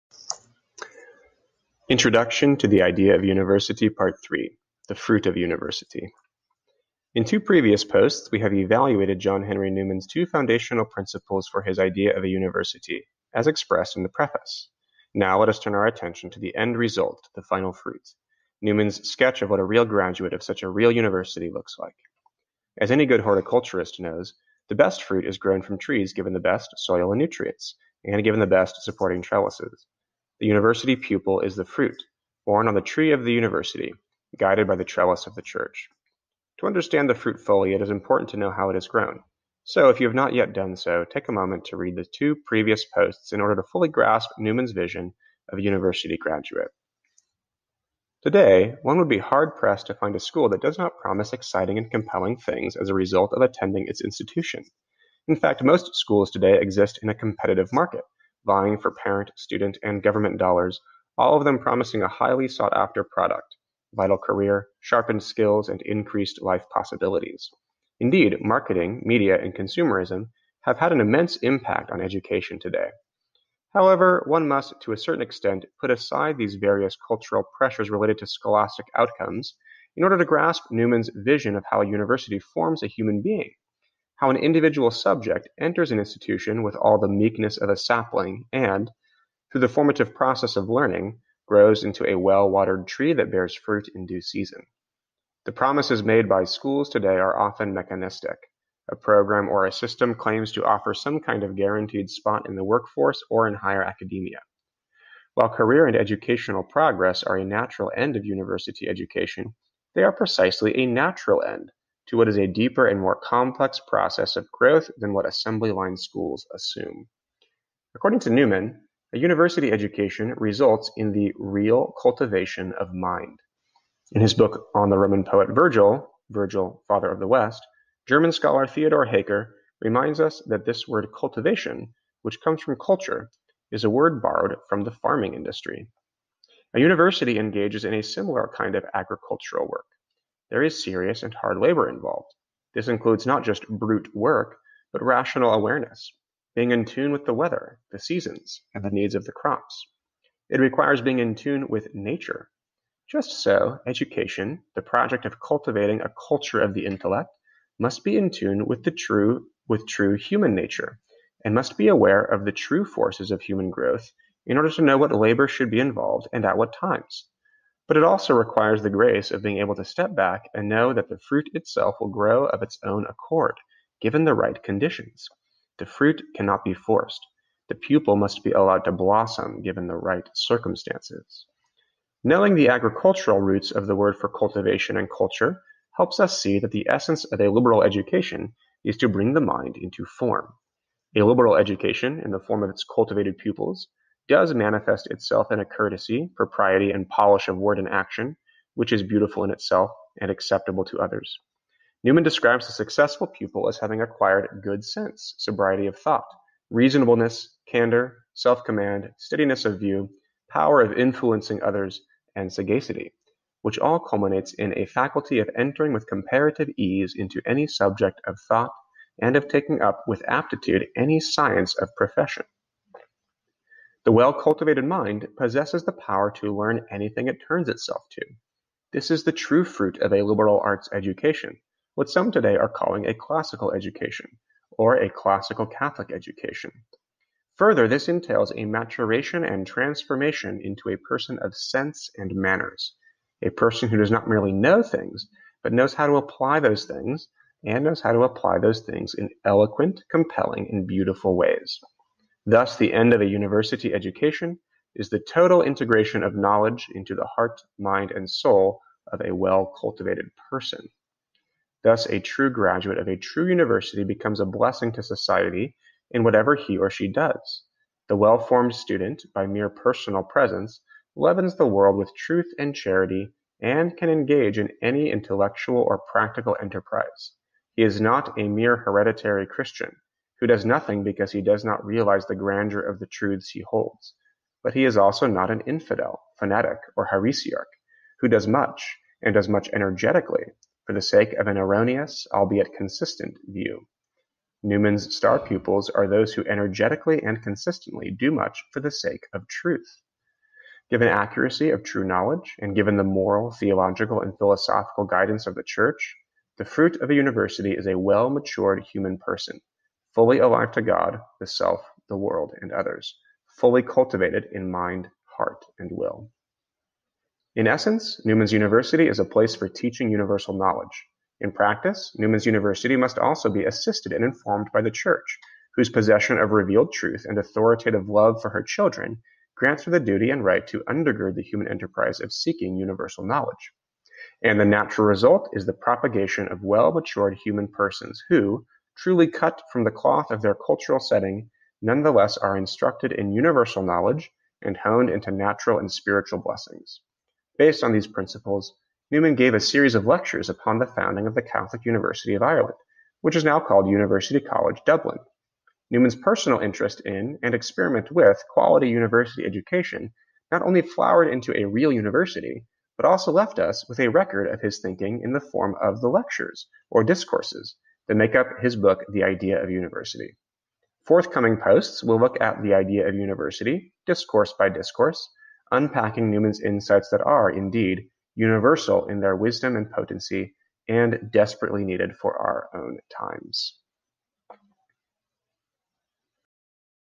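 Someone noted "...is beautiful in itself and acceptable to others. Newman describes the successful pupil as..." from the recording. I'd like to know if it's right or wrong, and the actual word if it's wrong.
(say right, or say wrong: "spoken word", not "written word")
right.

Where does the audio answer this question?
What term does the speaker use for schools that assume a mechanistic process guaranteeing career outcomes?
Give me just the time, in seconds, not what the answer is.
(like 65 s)
115 s.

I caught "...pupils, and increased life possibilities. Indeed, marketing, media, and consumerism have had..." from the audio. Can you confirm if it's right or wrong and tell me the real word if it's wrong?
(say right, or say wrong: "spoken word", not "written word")
wrong: "skills", not "pupils".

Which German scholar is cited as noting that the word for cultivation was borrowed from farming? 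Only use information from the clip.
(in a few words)
Theodor Haecker.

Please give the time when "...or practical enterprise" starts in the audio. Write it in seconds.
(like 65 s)
275 s.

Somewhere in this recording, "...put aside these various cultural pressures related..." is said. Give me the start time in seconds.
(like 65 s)
75 s.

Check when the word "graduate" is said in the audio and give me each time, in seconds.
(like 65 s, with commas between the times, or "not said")
19 s, 46 s, 262 s.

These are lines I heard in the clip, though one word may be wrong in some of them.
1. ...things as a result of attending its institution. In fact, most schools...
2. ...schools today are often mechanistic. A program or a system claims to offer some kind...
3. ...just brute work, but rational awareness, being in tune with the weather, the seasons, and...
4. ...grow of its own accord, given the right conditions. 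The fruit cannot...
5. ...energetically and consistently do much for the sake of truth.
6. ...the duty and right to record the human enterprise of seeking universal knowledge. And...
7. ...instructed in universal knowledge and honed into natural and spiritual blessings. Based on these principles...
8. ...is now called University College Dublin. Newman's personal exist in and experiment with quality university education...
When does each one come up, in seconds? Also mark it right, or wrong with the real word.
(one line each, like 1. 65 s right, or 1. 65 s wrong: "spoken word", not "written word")
1. 52 s right
2. 96 s right
3. 143 s right
4. 172 s right
5. 296 s right
6. 329 s wrong: "undergird", not "record"
7. 342 s right
8. 353 s wrong: "interest", not "exist".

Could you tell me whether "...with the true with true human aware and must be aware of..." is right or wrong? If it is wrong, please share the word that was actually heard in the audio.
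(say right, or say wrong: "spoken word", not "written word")
wrong: "nature", not "aware".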